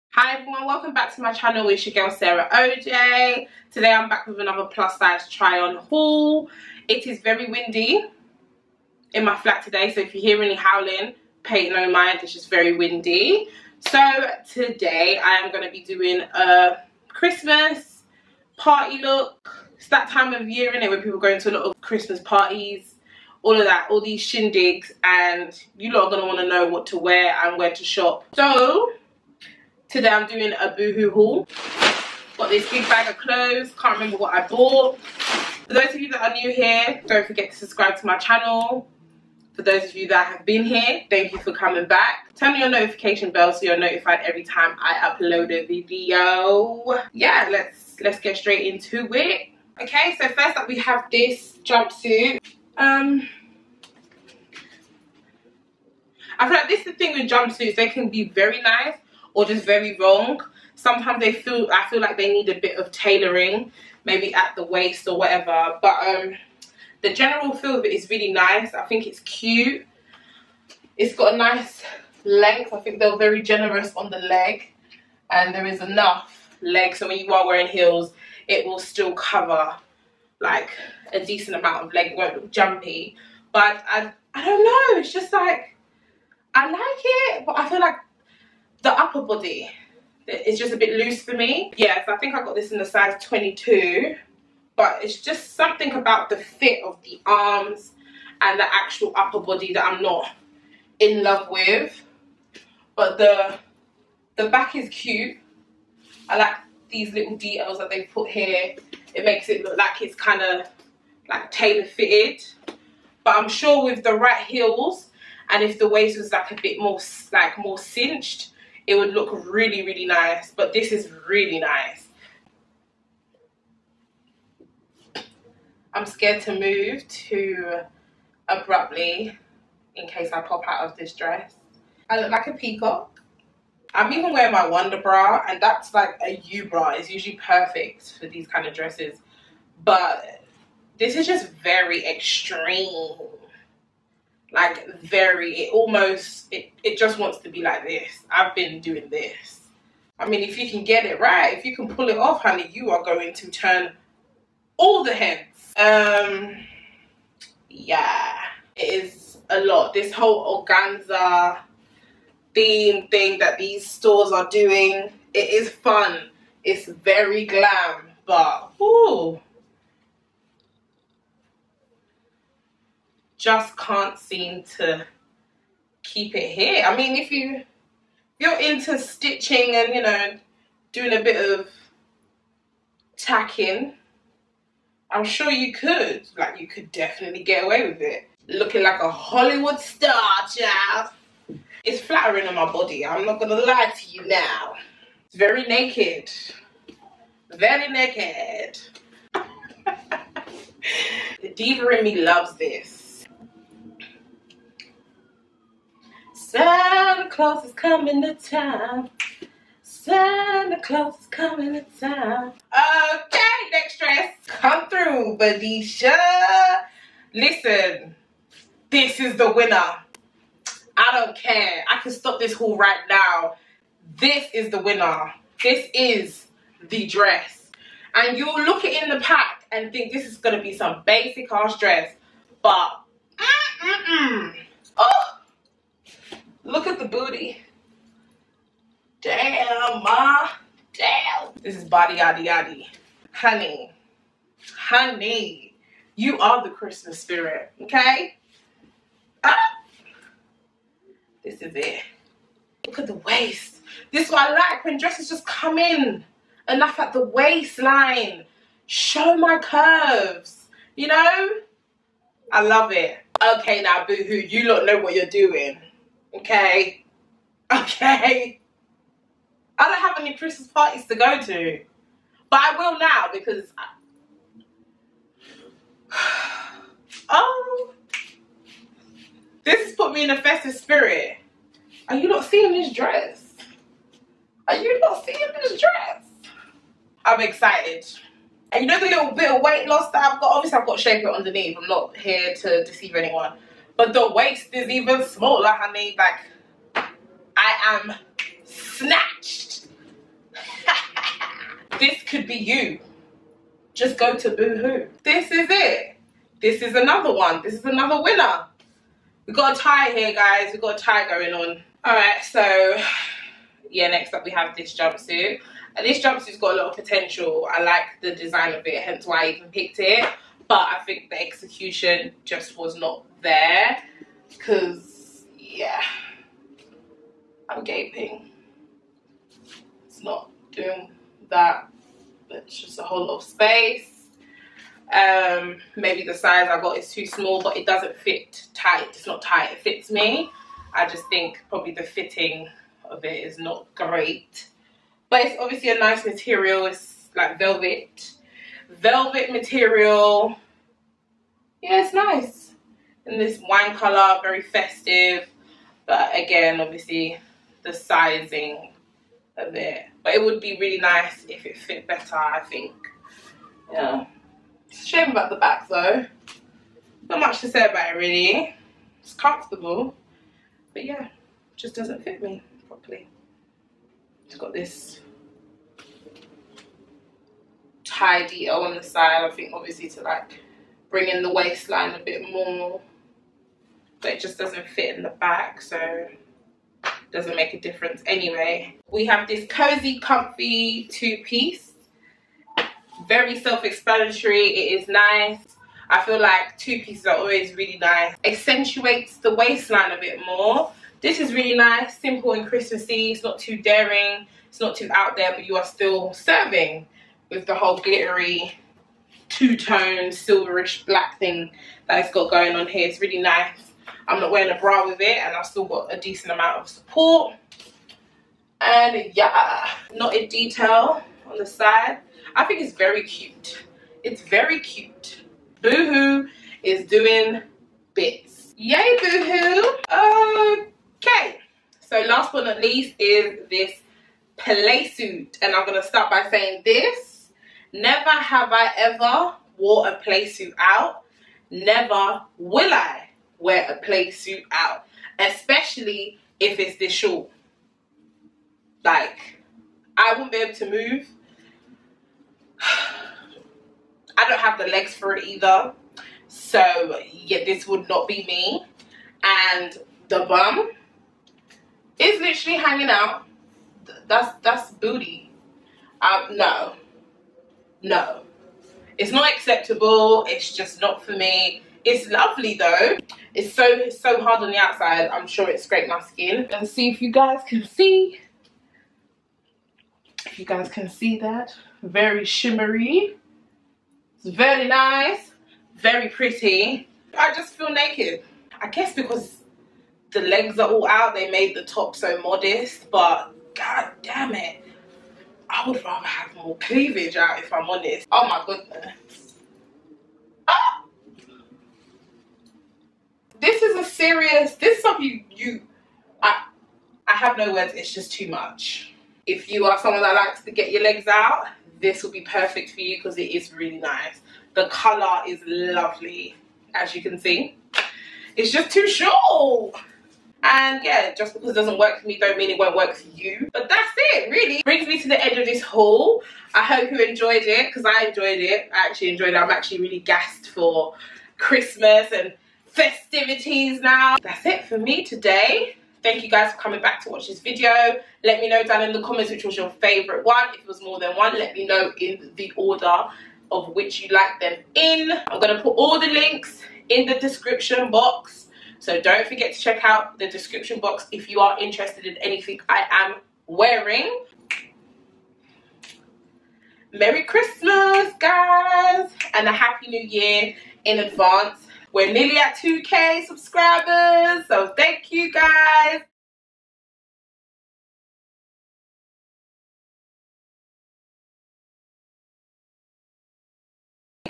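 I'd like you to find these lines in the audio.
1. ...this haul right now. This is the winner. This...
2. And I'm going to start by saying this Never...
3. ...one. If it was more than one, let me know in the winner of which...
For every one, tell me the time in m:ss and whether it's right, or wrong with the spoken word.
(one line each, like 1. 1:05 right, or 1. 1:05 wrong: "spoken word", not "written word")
1. 3:42 right
2. 7:15 right
3. 9:00 wrong: "order", not "winner".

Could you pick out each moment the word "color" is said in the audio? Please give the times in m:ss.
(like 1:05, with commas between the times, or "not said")
5:53, 8:34.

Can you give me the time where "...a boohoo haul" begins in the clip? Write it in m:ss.
0:30.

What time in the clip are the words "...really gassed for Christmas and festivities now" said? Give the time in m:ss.
8:50.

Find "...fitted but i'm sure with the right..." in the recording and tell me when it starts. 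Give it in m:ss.
1:51.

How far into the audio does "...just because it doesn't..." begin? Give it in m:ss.
8:41.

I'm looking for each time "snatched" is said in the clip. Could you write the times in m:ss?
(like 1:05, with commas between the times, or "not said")
4:58.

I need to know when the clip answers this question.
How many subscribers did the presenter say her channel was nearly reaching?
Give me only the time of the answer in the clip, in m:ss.
9:22.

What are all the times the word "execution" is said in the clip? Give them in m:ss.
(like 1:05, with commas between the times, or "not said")
5:21.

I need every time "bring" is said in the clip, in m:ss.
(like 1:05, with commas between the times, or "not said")
6:21, 8:44.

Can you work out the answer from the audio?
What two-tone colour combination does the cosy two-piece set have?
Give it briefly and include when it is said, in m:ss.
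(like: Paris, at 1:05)
Silverish black, at 6:50.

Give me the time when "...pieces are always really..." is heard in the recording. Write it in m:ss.
6:37.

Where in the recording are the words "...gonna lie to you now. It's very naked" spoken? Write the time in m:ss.
3:13.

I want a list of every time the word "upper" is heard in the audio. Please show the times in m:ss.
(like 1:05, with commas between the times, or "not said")
1:28, 1:39.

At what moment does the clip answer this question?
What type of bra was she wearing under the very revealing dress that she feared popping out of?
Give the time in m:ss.
2:14.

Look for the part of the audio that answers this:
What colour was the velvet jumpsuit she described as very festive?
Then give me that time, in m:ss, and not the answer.
5:53.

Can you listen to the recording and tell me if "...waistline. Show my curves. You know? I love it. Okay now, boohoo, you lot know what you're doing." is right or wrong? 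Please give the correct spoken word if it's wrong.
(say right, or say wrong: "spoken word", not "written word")
right.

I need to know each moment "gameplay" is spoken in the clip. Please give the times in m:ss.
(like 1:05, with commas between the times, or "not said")
not said.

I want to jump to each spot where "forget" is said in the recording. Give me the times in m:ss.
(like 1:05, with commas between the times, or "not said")
0:37, 9:09.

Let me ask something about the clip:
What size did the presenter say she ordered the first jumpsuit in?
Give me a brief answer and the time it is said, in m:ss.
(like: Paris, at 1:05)
22, at 1:32.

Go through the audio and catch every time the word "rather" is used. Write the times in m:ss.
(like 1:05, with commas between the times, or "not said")
8:16.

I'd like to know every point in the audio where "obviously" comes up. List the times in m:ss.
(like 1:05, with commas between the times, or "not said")
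4:50, 5:45, 5:56, 6:19.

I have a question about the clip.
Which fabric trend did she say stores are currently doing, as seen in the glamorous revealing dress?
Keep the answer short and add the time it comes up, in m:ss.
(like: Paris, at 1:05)
Organza, at 2:40.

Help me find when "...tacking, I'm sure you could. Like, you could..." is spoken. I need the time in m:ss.
3:03.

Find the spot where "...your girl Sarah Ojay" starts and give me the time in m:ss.
0:01.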